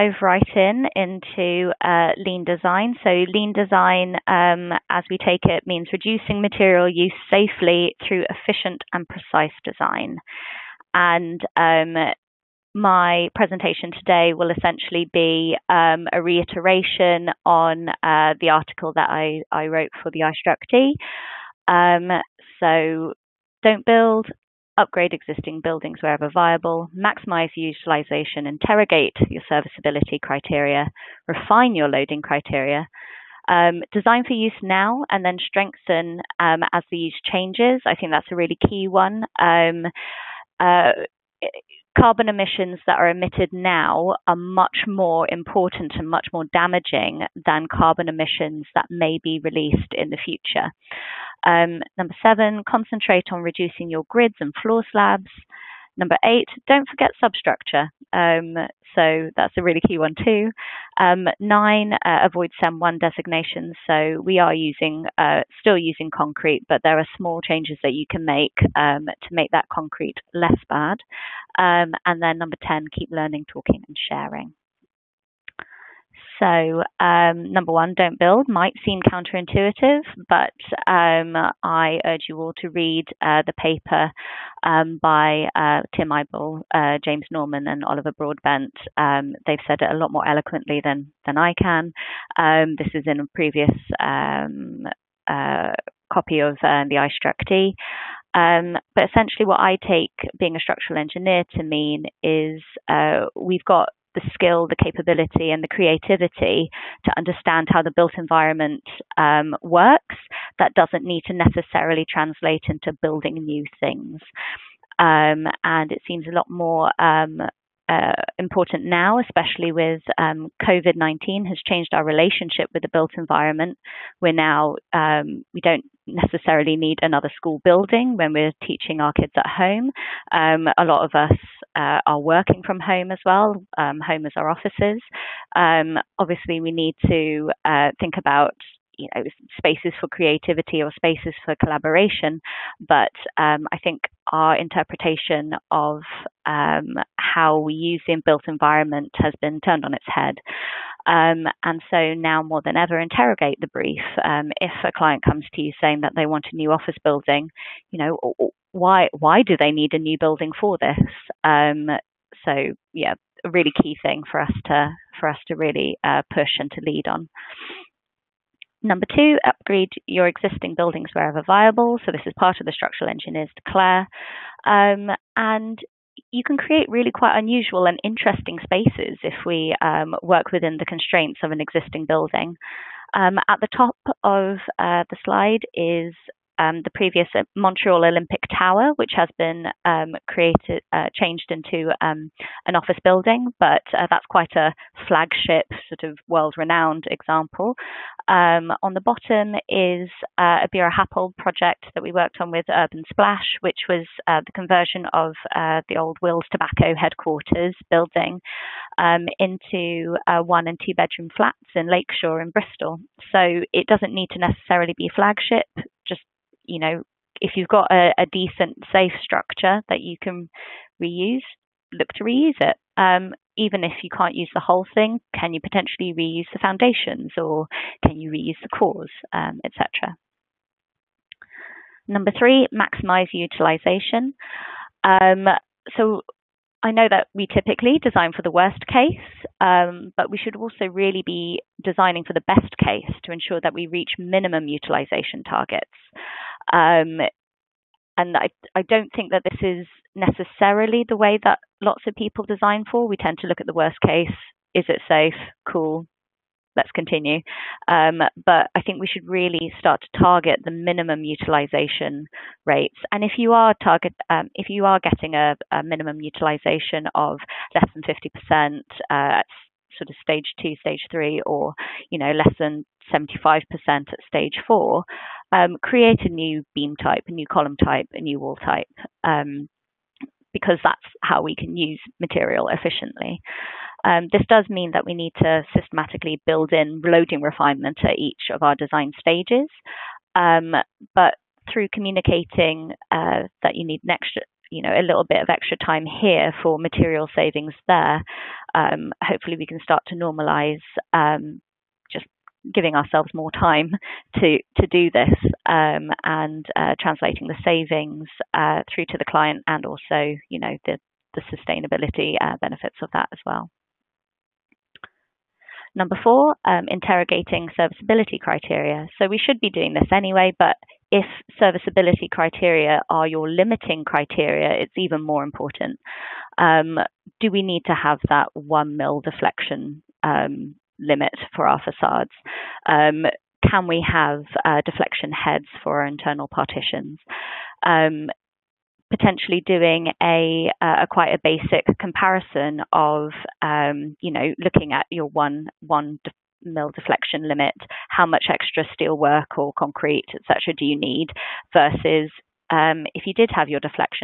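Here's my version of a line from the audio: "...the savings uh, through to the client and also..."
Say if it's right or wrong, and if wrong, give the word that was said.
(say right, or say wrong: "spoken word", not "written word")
right.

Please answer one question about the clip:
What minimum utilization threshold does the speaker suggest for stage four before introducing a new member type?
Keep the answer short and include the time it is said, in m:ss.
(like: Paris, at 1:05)
75%, at 4:33.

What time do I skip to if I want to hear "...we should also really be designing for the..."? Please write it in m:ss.
4:00.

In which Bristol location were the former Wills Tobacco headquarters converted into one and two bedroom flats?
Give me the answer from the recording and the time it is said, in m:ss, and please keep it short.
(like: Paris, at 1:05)
Lakeshore, at 3:31.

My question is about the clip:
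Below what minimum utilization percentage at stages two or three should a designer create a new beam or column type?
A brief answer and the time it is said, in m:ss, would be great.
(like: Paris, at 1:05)
50%, at 4:28.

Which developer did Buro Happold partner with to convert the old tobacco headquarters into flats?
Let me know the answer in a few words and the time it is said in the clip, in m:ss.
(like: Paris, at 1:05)
Urban Splash, at 3:22.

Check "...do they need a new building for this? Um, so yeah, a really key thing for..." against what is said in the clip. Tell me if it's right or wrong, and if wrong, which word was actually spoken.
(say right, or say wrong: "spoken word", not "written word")
right.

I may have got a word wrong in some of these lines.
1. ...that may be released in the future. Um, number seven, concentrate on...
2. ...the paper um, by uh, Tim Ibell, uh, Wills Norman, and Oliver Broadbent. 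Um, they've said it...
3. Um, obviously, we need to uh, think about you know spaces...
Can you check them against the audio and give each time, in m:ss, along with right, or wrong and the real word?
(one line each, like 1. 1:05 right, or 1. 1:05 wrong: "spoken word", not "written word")
1. 0:48 right
2. 1:23 wrong: "James", not "Wills"
3. 2:15 right.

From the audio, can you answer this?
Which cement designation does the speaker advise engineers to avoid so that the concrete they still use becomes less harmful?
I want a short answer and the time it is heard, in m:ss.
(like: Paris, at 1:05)
CEM1, at 1:02.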